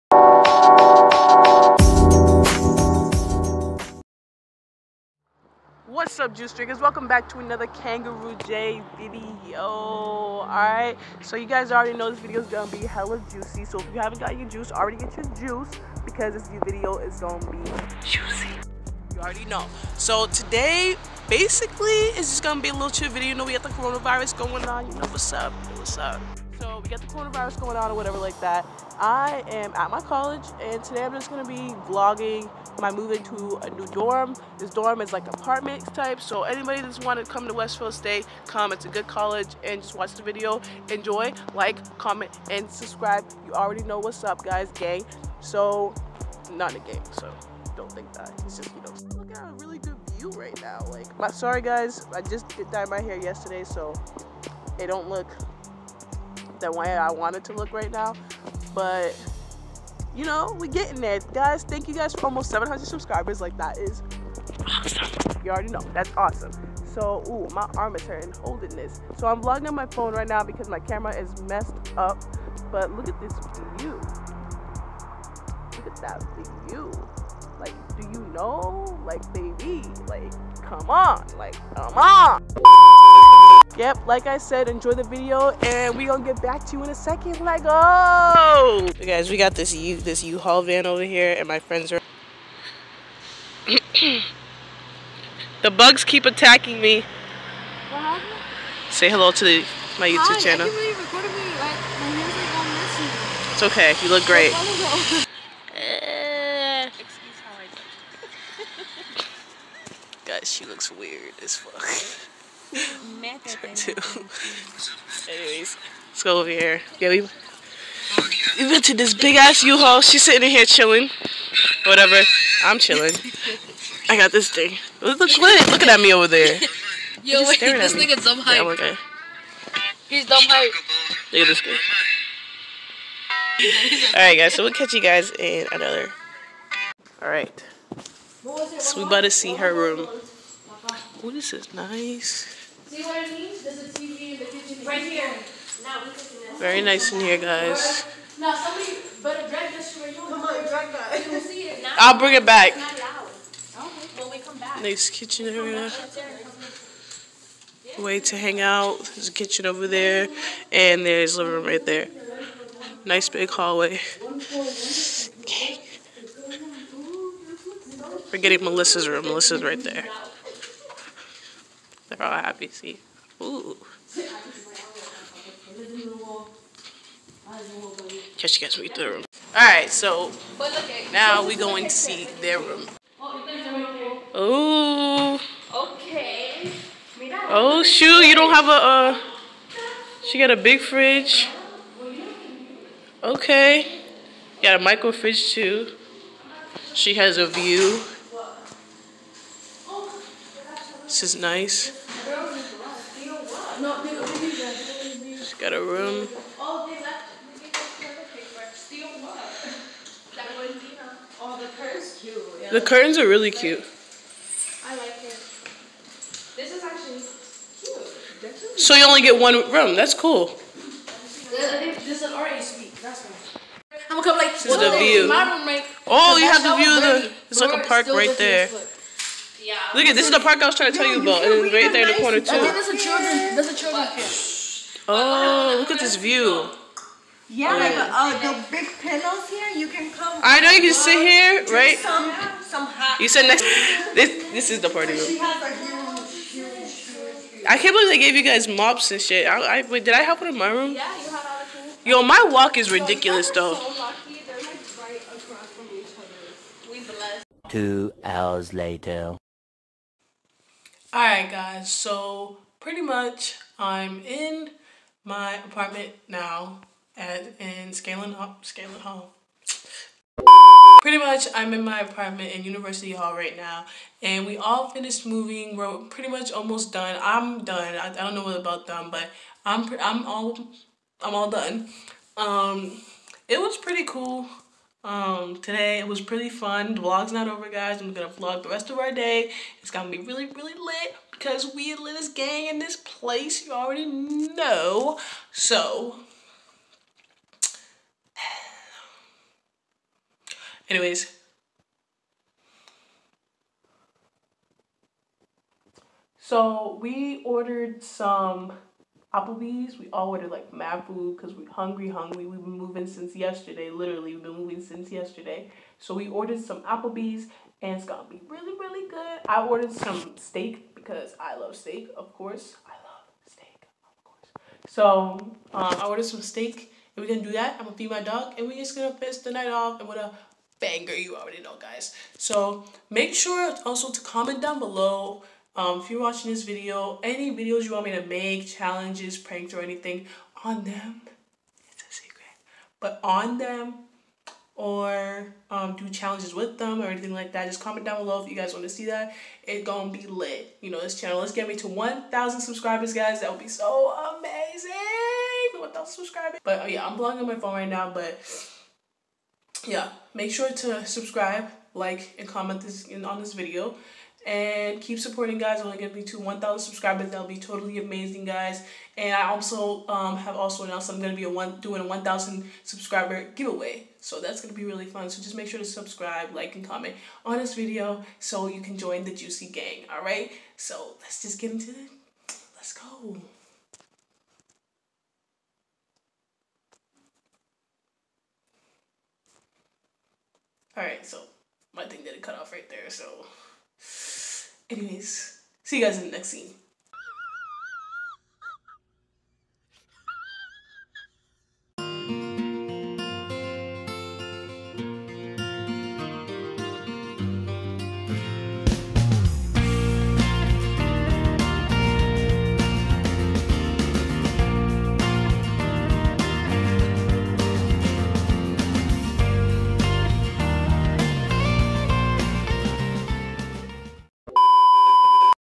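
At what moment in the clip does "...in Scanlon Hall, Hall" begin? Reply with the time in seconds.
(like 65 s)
267 s.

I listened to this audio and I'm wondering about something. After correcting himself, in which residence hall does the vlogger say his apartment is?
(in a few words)
University Hall.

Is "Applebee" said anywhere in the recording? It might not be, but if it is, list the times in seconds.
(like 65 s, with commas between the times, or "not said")
309 s, 316 s.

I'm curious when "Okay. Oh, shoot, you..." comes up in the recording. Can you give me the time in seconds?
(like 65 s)
185 s.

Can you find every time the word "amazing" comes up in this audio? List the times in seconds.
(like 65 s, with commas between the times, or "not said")
354 s, 367 s.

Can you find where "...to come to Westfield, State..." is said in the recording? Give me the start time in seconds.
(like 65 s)
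37 s.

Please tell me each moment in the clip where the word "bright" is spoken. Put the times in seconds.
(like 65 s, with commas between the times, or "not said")
not said.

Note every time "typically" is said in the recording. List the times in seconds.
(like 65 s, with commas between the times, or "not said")
not said.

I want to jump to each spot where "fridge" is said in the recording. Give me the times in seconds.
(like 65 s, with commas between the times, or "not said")
190 s, 195 s.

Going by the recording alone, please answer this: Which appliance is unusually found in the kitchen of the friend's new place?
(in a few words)
TV.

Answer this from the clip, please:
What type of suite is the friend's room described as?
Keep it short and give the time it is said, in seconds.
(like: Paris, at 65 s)
RA suite, at 222 s.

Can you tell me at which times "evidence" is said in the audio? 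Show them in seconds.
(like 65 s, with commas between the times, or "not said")
not said.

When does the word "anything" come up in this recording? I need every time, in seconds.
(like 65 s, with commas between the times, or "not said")
339 s, 347 s.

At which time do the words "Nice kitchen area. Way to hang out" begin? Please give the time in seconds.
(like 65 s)
154 s.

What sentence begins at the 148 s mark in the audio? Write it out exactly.
Now somebody better drag this for you.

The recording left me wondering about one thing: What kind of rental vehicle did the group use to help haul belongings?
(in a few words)
U-Haul van.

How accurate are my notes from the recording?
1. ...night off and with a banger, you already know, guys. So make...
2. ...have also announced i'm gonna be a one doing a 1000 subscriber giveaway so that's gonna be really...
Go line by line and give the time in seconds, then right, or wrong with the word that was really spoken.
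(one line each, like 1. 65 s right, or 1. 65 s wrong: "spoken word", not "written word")
1. 329 s right
2. 370 s right.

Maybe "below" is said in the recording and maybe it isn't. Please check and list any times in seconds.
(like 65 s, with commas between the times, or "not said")
334 s, 348 s.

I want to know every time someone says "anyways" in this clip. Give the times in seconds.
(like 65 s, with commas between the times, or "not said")
115 s, 300 s, 394 s.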